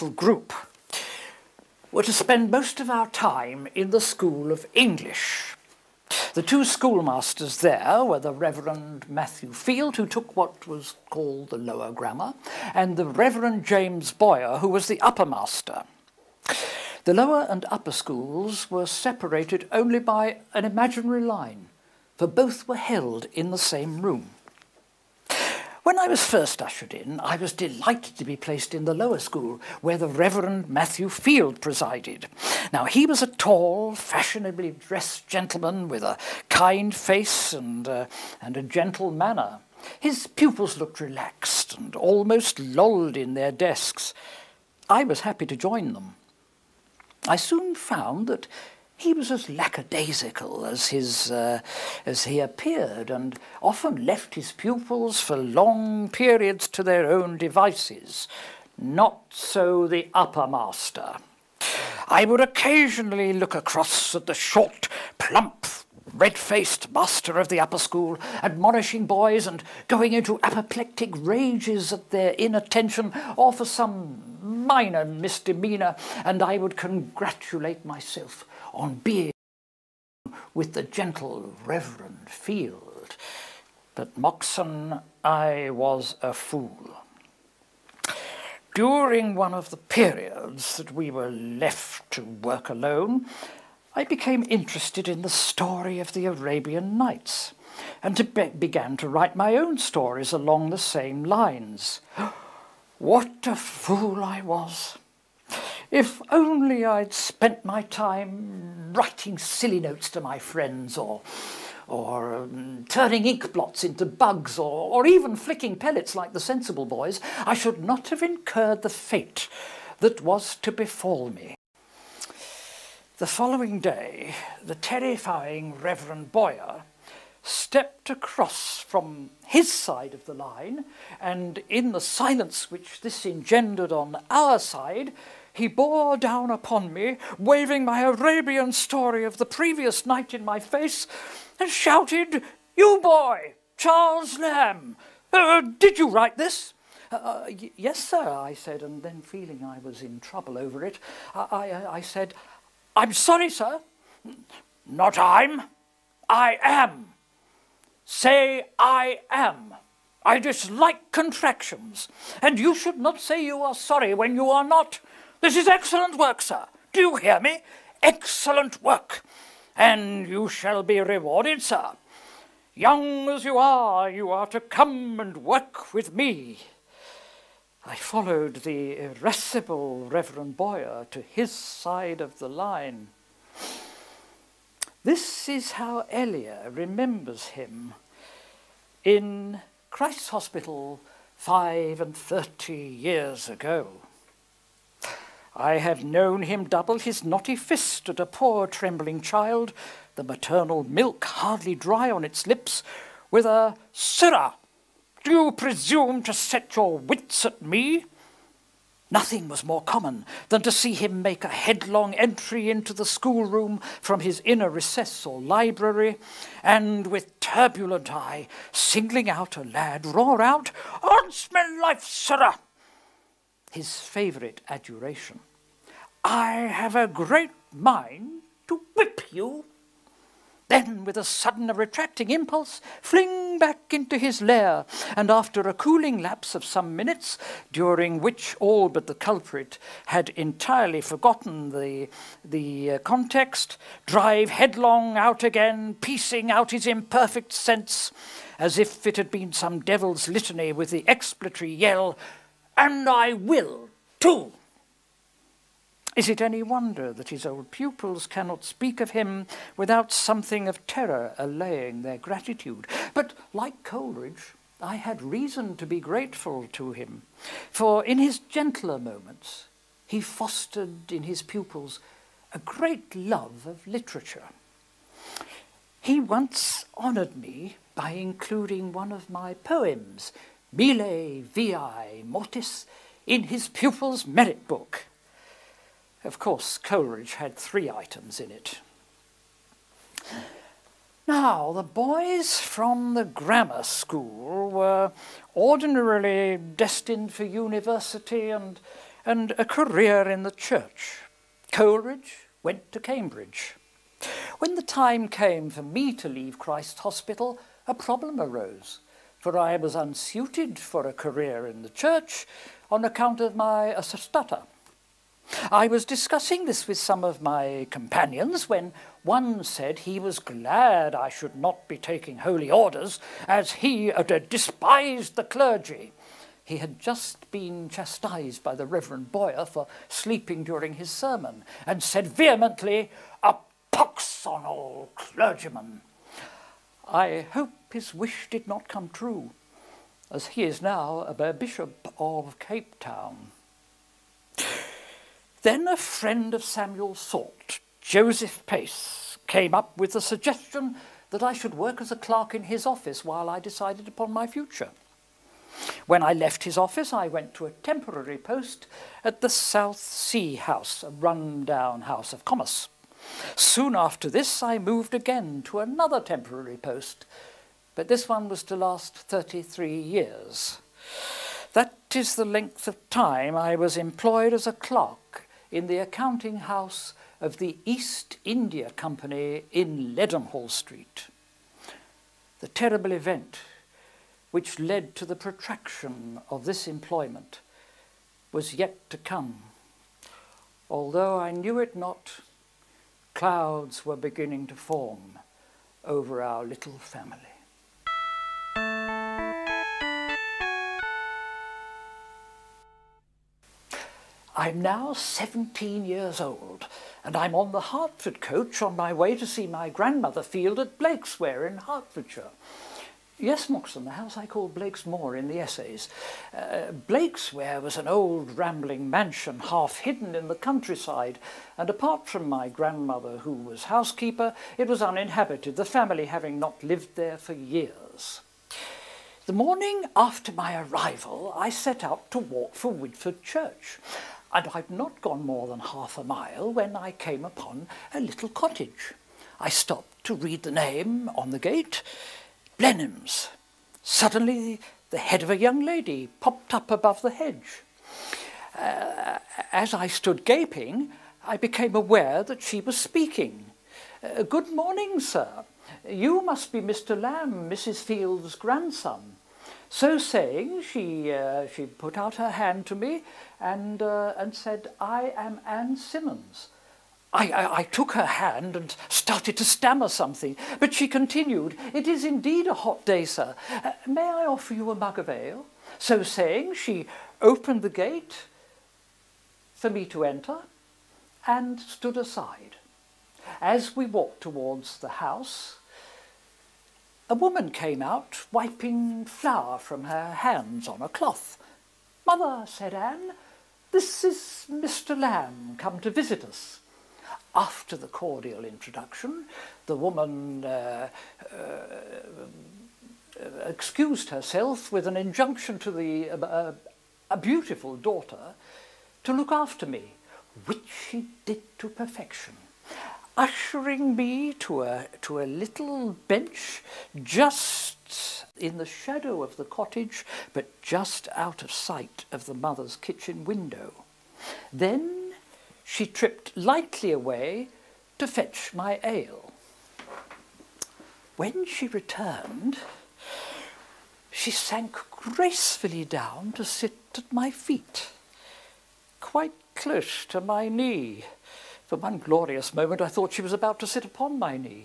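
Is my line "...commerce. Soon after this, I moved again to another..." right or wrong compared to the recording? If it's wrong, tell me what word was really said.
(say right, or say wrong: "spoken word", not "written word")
right.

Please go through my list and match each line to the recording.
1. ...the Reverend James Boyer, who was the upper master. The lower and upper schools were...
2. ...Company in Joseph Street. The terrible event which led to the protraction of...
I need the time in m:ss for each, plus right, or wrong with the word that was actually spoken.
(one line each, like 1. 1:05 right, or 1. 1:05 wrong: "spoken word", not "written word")
1. 0:12 right
2. 6:18 wrong: "Leadenhall", not "Joseph".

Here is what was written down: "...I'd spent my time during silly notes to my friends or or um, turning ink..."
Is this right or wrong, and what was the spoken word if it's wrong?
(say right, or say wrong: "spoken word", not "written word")
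wrong: "writing", not "during".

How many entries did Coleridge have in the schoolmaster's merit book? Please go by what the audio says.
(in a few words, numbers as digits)
3.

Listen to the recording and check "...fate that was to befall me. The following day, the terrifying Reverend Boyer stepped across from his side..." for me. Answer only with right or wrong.
right.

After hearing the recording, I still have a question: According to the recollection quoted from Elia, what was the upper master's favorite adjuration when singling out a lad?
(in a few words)
On's life, sirrah!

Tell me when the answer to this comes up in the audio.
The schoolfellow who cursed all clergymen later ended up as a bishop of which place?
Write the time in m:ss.
5:42.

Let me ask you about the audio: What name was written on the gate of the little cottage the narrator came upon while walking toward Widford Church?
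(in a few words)
Blenheim's.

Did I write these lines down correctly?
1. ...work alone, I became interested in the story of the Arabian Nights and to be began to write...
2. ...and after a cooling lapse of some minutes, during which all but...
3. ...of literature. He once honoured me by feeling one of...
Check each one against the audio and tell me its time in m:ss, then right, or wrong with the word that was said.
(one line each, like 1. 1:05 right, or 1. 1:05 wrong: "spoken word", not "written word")
1. 1:32 right
2. 3:55 right
3. 4:33 wrong: "including", not "feeling".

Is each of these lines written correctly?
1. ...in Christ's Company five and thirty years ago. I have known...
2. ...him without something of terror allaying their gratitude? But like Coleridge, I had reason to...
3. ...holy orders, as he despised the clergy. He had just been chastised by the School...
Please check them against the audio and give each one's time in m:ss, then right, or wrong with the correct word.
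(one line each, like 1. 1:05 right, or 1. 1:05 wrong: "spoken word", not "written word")
1. 3:09 wrong: "Hospital", not "Company"
2. 4:19 right
3. 5:22 wrong: "Reverend", not "School".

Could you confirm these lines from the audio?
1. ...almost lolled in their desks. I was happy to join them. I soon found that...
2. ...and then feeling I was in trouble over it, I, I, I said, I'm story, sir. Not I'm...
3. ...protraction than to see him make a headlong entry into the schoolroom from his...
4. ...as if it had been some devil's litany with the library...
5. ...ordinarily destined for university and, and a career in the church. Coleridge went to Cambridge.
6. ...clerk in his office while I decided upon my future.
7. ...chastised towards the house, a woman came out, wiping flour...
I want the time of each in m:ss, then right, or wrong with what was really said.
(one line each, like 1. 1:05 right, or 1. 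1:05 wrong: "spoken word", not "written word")
1. 0:41 right
2. 2:28 wrong: "sorry", not "story"
3. 3:29 wrong: "common", not "protraction"
4. 4:08 wrong: "expletory", not "library"
5. 4:55 right
6. 5:52 right
7. 8:04 wrong: "walked", not "chastised".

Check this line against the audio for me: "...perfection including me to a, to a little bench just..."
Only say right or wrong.
wrong.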